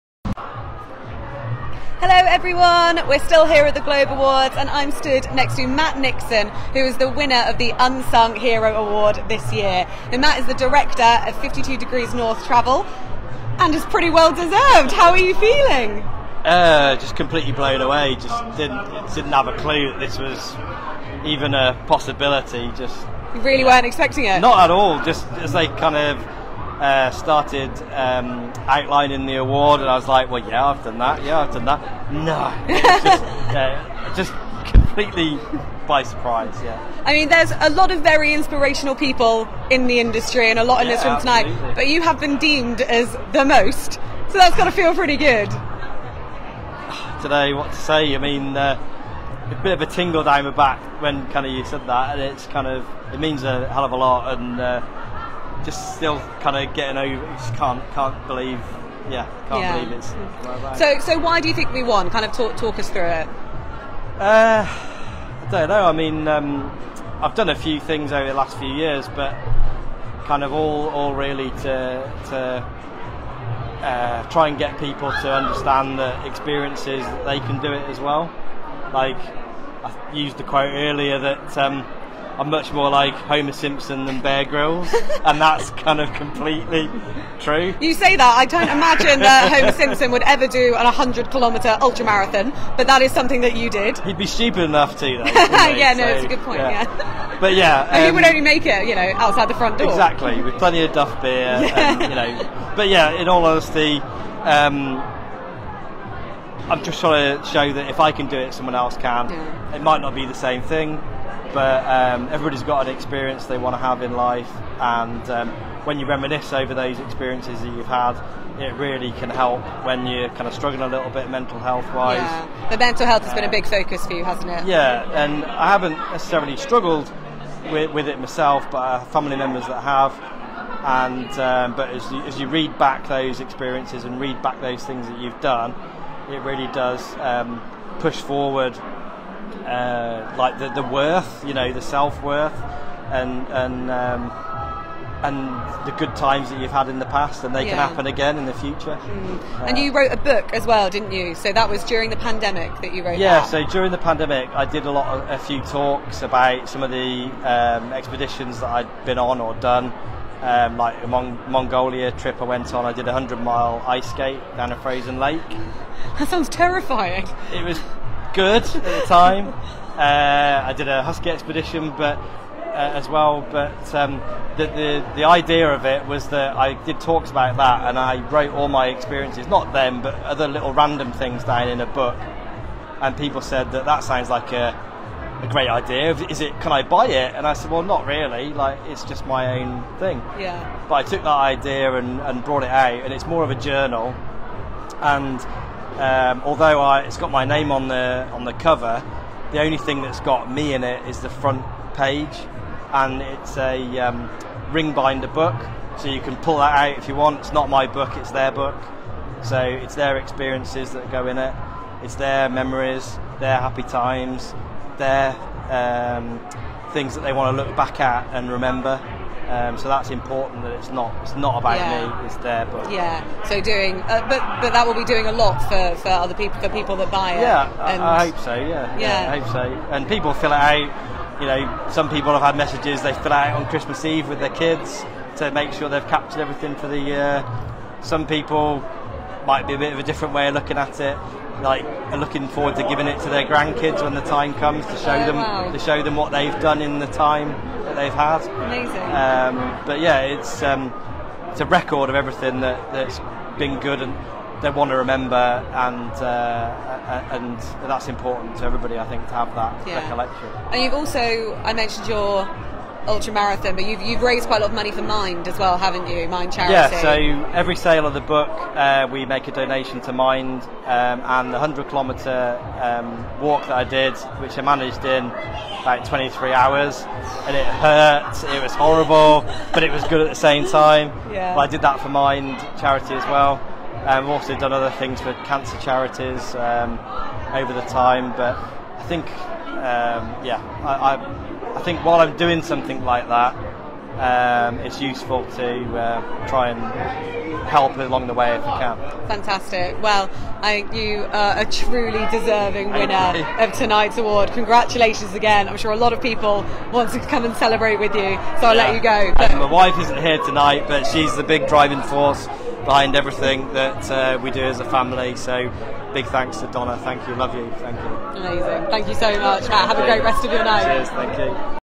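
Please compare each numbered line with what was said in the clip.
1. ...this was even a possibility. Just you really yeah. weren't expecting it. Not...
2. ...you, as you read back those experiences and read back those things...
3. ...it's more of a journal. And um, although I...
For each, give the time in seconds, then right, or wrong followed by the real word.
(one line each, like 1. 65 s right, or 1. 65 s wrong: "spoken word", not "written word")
1. 19 s right
2. 132 s right
3. 193 s right.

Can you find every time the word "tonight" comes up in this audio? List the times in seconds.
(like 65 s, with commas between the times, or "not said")
41 s, 303 s, 310 s.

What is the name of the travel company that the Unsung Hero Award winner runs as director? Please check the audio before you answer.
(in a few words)
52 Degrees North Travel.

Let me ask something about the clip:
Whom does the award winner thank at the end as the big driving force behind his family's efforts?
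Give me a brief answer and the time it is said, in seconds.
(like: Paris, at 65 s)
Donna, at 316 s.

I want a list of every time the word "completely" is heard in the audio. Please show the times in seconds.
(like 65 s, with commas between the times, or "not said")
17 s, 34 s, 86 s.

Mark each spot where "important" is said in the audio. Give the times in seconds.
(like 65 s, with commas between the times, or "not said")
220 s, 258 s.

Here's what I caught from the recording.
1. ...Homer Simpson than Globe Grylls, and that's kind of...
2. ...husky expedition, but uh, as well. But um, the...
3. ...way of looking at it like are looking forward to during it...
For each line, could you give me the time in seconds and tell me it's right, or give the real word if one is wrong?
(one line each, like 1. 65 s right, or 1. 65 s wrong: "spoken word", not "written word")
1. 83 s wrong: "Bear", not "Globe"
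2. 171 s right
3. 240 s wrong: "giving", not "during".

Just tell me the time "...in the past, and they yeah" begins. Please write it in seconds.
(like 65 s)
146 s.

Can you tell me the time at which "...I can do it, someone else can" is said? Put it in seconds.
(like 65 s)
107 s.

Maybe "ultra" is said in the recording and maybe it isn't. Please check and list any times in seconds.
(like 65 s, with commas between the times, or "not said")
91 s, 263 s.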